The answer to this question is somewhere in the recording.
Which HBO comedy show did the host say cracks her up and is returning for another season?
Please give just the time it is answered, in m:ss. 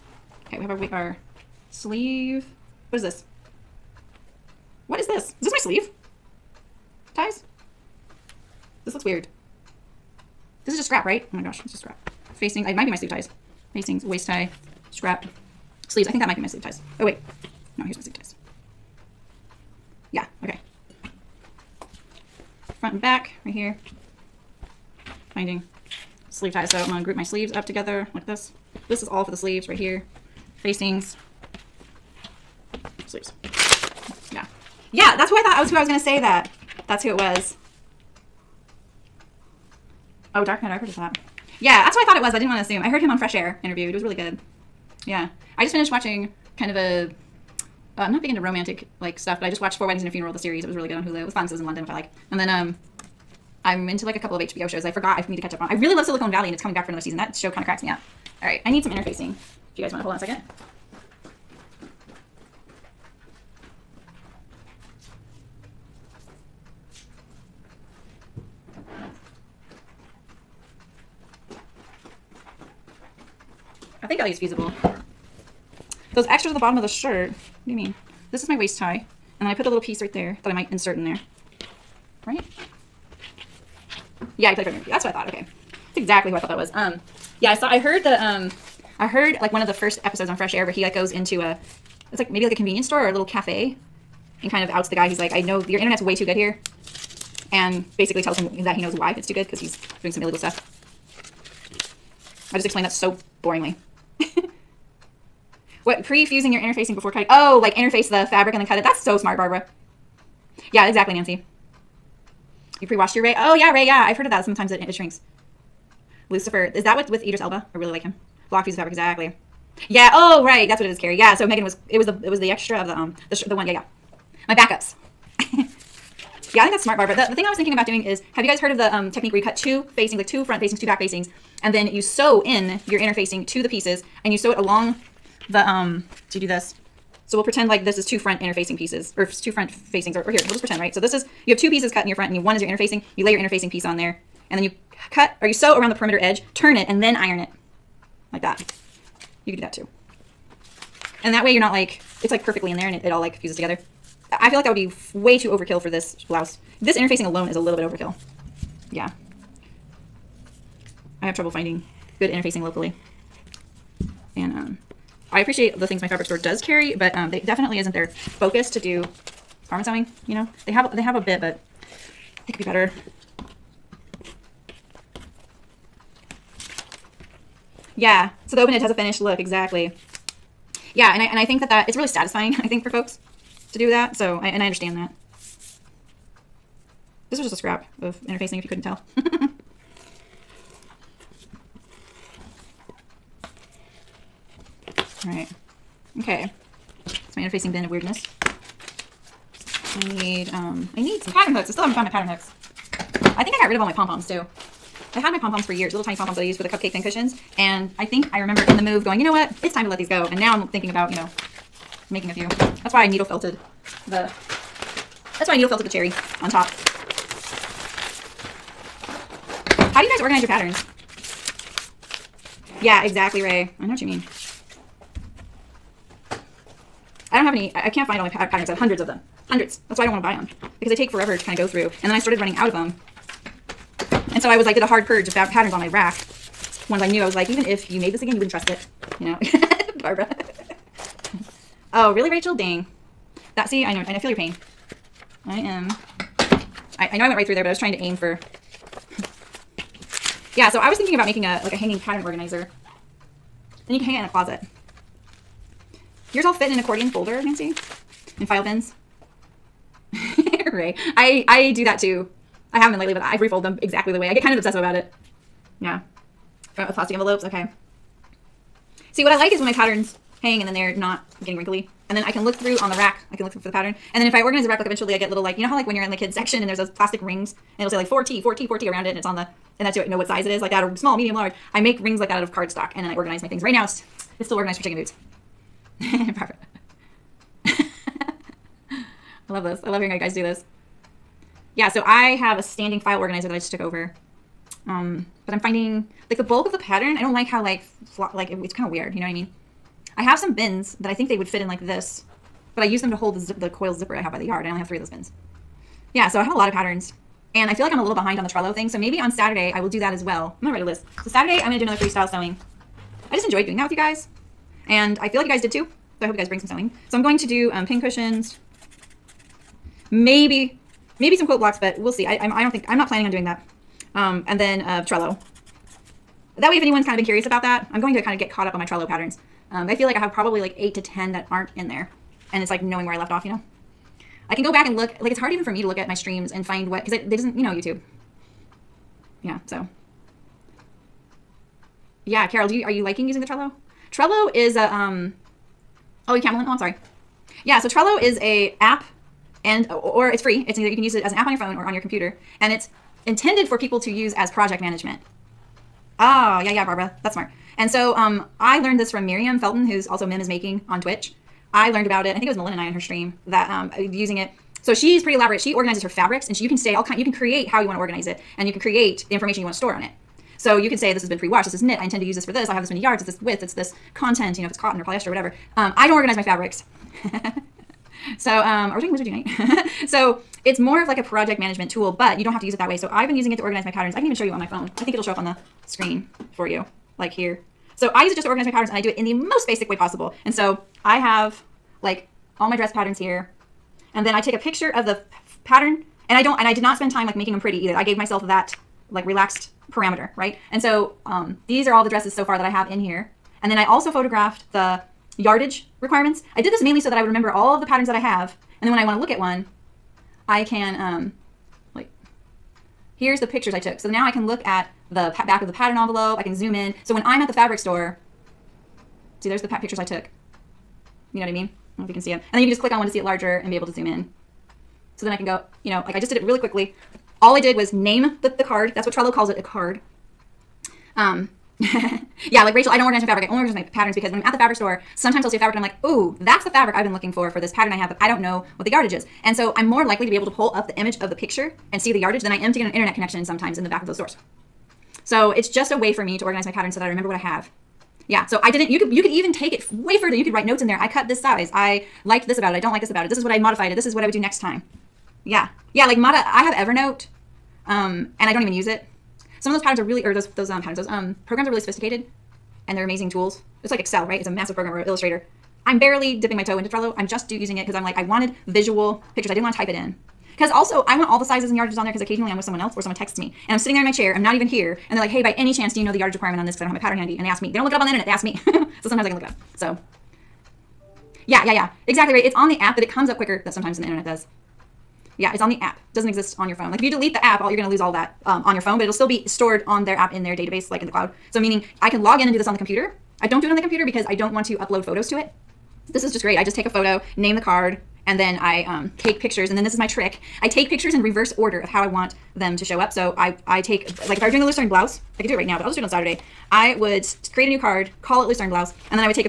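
0:56.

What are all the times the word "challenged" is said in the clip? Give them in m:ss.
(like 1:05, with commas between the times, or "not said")
not said.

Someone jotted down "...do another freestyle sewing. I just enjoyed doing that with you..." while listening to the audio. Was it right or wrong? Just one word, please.
right.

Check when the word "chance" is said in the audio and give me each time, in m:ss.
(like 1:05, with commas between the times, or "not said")
7:55.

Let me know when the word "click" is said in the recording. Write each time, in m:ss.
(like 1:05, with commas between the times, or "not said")
7:02.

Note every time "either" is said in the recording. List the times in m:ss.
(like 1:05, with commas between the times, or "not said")
5:50, 6:37.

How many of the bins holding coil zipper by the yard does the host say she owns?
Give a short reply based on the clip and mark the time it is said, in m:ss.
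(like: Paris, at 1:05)
3, at 5:04.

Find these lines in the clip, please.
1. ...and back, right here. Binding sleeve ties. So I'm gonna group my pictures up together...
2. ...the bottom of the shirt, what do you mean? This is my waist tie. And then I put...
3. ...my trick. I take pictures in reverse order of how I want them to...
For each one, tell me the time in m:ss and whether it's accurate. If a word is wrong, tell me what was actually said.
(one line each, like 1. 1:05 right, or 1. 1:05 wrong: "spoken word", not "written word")
1. 0:22 wrong: "sleeves", not "pictures"
2. 1:16 right
3. 8:19 right.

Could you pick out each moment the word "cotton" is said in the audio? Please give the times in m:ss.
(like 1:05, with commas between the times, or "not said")
6:14.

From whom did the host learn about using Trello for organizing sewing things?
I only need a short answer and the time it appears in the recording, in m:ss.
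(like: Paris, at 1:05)
Miriam Felton, at 5:59.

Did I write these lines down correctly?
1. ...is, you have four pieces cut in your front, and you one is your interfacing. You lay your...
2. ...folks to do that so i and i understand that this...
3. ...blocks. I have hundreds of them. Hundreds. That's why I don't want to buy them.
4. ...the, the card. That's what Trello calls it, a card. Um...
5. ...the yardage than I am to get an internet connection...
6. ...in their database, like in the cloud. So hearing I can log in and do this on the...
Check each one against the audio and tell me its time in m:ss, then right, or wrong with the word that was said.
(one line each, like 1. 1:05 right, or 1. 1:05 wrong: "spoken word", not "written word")
1. 2:21 wrong: "two", not "four"
2. 3:02 right
3. 3:48 wrong: "books", not "blocks"
4. 7:08 right
5. 7:22 right
6. 8:10 wrong: "meaning", not "hearing".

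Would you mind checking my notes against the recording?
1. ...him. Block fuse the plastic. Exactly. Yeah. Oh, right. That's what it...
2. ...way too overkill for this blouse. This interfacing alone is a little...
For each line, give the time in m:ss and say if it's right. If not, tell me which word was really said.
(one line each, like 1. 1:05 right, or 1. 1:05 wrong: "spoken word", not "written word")
1. 1:58 wrong: "fabric", not "plastic"
2. 2:35 right.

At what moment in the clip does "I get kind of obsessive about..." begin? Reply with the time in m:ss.
4:24.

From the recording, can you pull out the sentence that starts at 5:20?
Maybe, maybe some quote blocks, but we'll see.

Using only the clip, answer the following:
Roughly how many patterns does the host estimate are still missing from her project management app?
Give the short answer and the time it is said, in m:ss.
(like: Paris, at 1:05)
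8 to 10, at 5:30.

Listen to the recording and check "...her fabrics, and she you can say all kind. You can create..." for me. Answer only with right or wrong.
right.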